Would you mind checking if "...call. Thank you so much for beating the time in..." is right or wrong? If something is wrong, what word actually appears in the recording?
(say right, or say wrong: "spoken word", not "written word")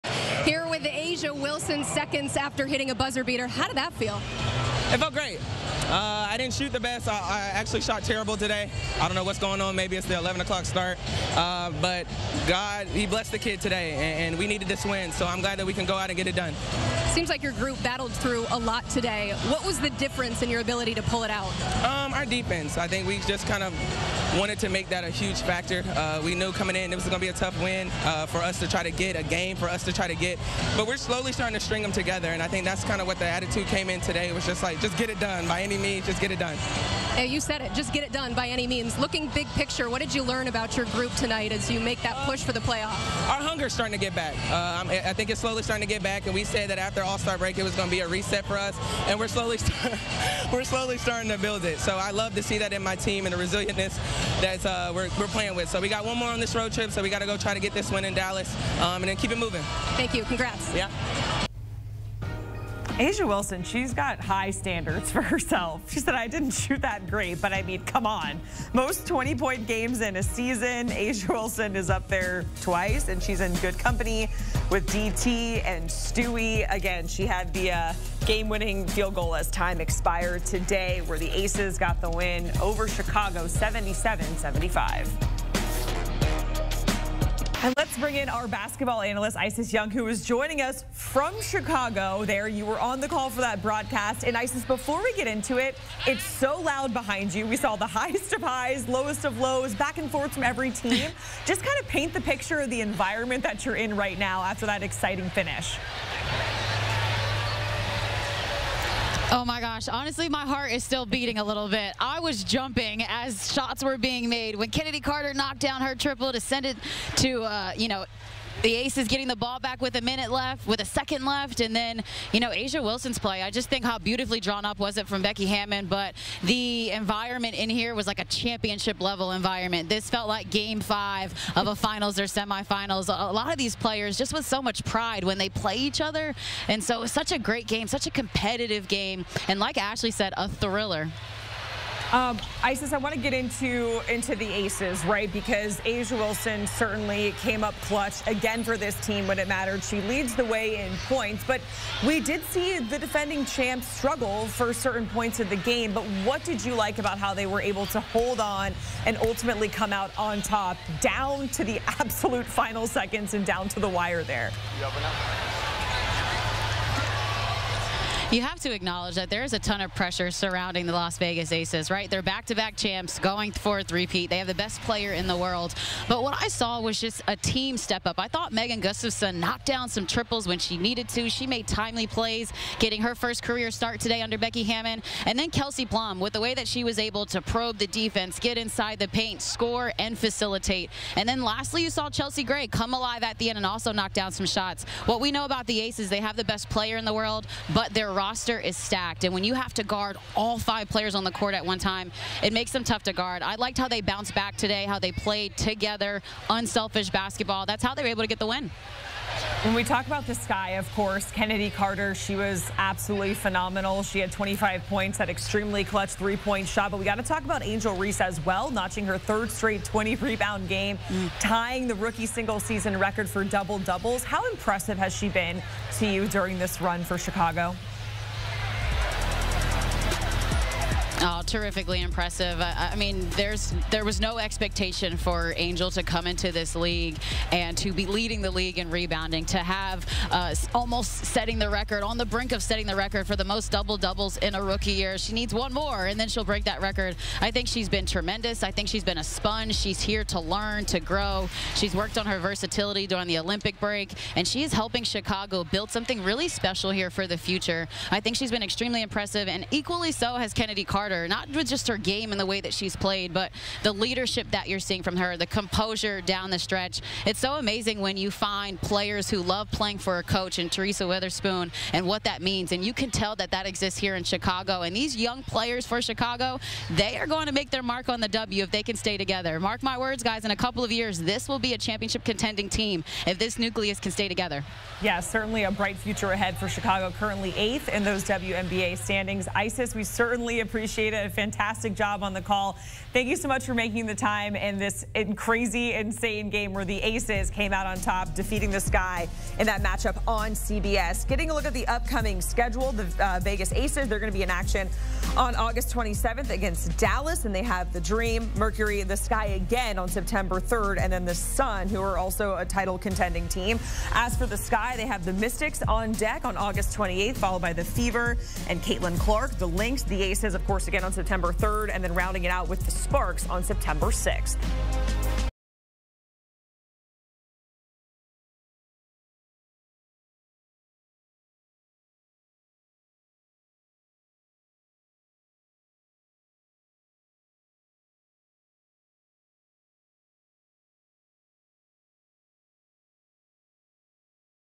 wrong: "making", not "beating".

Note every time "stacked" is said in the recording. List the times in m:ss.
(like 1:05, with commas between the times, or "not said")
3:18.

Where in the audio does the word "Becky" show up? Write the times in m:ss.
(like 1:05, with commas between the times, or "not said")
2:05, 3:04.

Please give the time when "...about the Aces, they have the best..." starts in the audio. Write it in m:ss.
3:15.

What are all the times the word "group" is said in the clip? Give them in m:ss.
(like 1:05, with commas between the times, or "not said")
0:17, 0:40.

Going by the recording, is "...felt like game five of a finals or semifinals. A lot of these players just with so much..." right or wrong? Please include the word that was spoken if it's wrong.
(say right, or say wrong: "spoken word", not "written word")
right.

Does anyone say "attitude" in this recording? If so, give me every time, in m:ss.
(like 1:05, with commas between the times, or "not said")
0:33.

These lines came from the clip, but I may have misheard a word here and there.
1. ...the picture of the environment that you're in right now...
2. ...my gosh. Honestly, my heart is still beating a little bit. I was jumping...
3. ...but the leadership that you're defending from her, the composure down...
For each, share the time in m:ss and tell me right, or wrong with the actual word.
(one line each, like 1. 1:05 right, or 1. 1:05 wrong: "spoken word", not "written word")
1. 1:42 right
2. 1:49 right
3. 4:23 wrong: "seeing", not "defending".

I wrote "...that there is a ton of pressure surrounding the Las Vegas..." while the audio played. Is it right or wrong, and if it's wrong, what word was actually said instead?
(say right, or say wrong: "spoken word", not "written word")
right.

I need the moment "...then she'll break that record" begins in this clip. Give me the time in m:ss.
4:06.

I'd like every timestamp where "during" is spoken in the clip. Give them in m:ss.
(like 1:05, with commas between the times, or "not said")
3:46, 4:13.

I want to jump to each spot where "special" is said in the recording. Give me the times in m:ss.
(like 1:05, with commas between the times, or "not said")
4:16.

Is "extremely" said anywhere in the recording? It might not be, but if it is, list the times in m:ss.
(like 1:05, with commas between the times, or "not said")
3:35, 4:18.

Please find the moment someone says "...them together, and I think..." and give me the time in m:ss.
0:31.